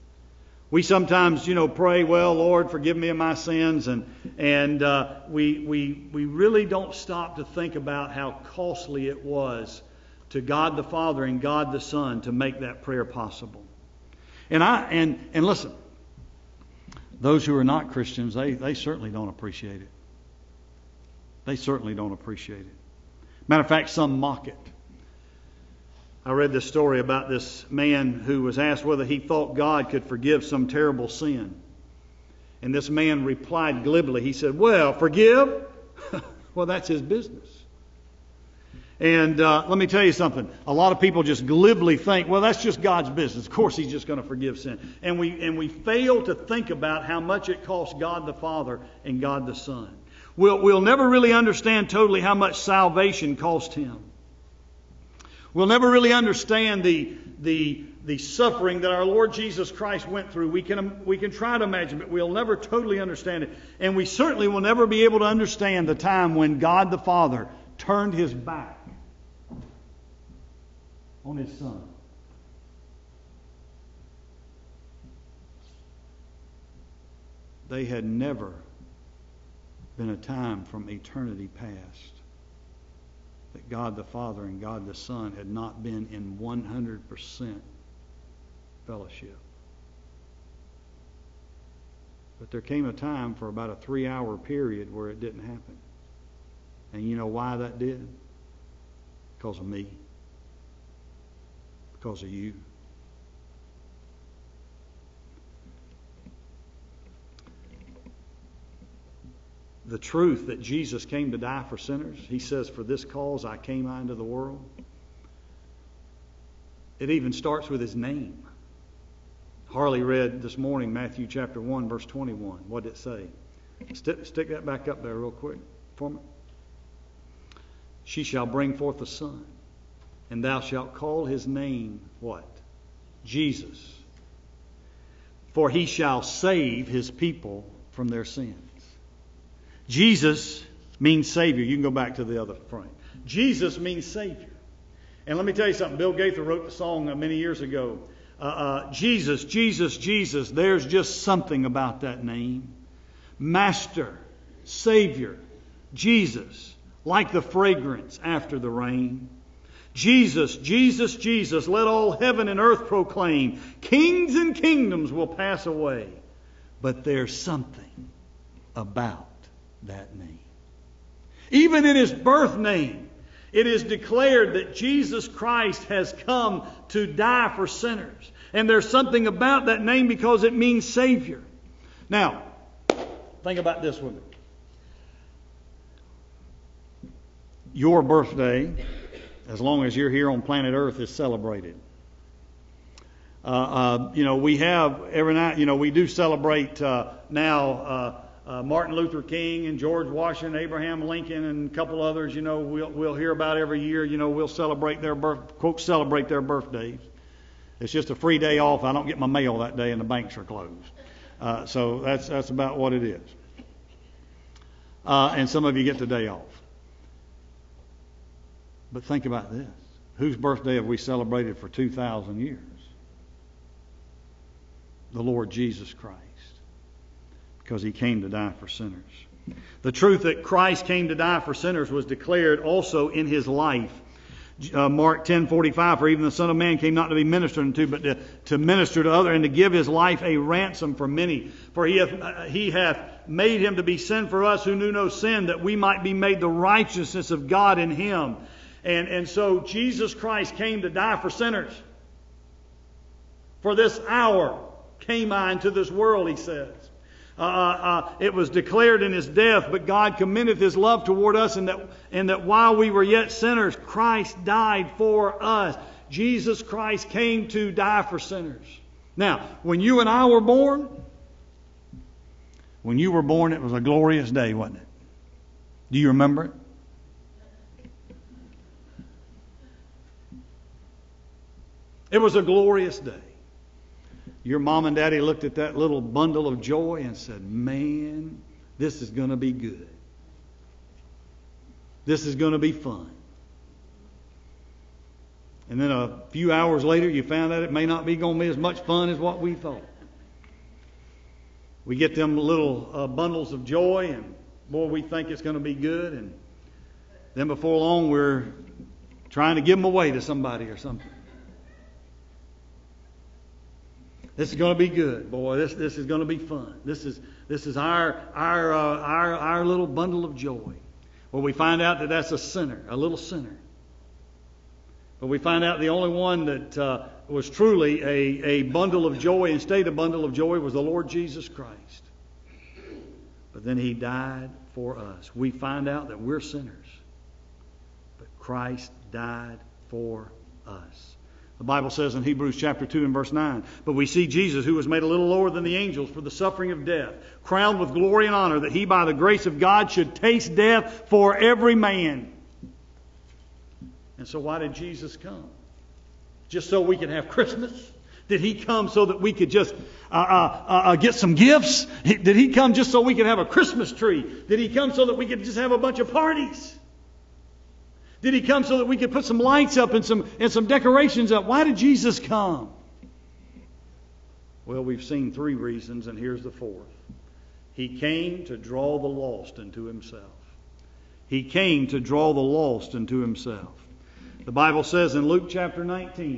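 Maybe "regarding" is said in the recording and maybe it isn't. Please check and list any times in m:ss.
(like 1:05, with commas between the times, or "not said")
not said.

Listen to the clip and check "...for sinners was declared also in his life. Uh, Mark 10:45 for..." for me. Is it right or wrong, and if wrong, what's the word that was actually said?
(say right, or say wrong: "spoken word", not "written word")
right.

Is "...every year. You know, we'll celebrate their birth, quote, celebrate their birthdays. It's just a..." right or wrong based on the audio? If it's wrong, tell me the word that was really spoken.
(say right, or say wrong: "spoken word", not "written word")
right.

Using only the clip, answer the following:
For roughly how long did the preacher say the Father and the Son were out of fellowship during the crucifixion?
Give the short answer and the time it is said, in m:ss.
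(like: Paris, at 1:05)
3 hours, at 1:33.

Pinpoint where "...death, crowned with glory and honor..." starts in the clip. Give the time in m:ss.
5:46.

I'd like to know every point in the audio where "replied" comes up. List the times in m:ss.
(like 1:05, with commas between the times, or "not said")
0:33.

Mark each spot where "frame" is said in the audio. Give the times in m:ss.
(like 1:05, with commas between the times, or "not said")
2:22.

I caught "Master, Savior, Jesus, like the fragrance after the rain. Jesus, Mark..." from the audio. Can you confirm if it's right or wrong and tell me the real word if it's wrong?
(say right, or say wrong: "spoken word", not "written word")
wrong: "Jesus", not "Mark".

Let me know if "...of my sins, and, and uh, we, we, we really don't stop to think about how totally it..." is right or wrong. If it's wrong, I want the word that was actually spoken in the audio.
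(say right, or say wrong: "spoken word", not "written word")
wrong: "costly", not "totally".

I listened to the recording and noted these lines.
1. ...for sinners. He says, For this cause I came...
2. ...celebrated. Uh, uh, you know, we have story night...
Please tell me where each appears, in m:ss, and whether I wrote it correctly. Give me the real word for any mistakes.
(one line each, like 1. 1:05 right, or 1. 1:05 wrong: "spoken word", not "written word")
1. 1:51 right
2. 3:11 wrong: "every", not "story".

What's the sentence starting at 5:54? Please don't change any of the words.
And so, why did Jesus come?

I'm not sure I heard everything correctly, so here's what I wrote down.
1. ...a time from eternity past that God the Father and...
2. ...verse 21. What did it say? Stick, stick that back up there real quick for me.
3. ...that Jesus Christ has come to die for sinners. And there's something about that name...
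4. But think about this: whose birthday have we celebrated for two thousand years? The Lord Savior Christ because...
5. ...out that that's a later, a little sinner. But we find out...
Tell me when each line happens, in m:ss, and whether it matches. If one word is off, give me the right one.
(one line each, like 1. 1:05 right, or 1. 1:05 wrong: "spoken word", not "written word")
1. 1:20 right
2. 2:01 right
3. 2:54 right
4. 3:38 wrong: "Jesus", not "Savior"
5. 5:21 wrong: "sinner", not "later".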